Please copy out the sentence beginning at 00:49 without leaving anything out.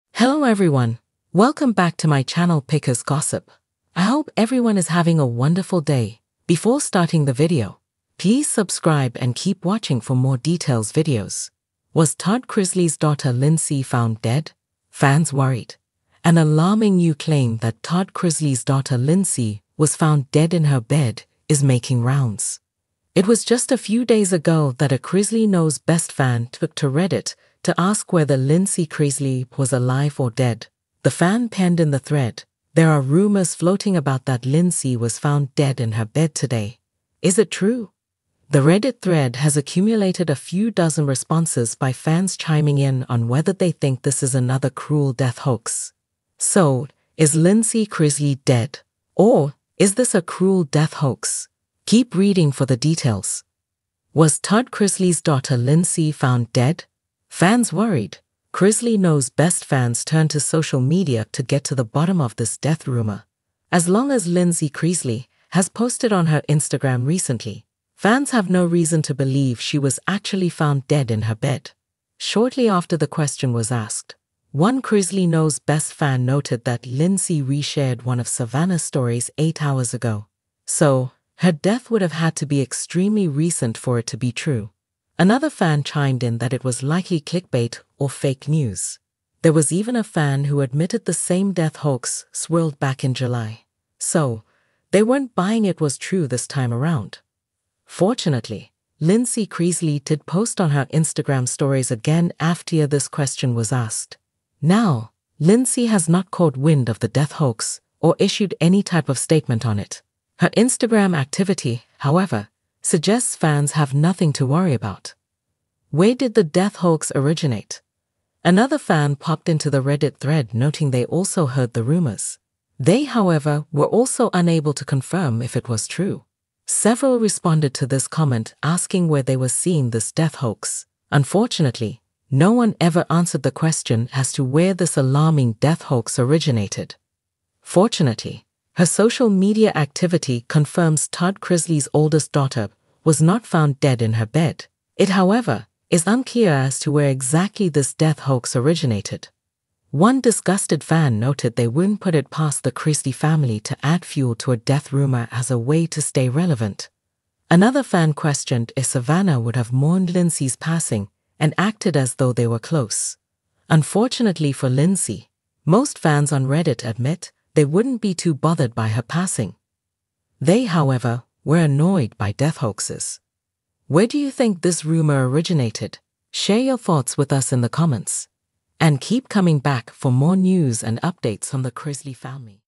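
Or is this a cruel death hoax?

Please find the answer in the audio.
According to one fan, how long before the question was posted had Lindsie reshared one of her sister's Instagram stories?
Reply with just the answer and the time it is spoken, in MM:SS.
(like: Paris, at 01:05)
8 hours, at 01:19.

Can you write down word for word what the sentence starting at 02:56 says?
Share your thoughts with us in the comments.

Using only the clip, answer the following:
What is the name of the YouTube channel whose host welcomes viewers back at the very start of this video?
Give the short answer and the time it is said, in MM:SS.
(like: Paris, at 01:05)
Pickers Gossip, at 00:02.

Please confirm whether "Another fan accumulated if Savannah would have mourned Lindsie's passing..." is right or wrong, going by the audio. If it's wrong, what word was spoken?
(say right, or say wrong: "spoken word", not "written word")
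wrong: "questioned", not "accumulated".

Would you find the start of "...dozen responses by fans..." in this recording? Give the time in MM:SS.
00:40.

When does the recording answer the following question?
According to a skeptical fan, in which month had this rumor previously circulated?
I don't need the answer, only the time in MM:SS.
01:33.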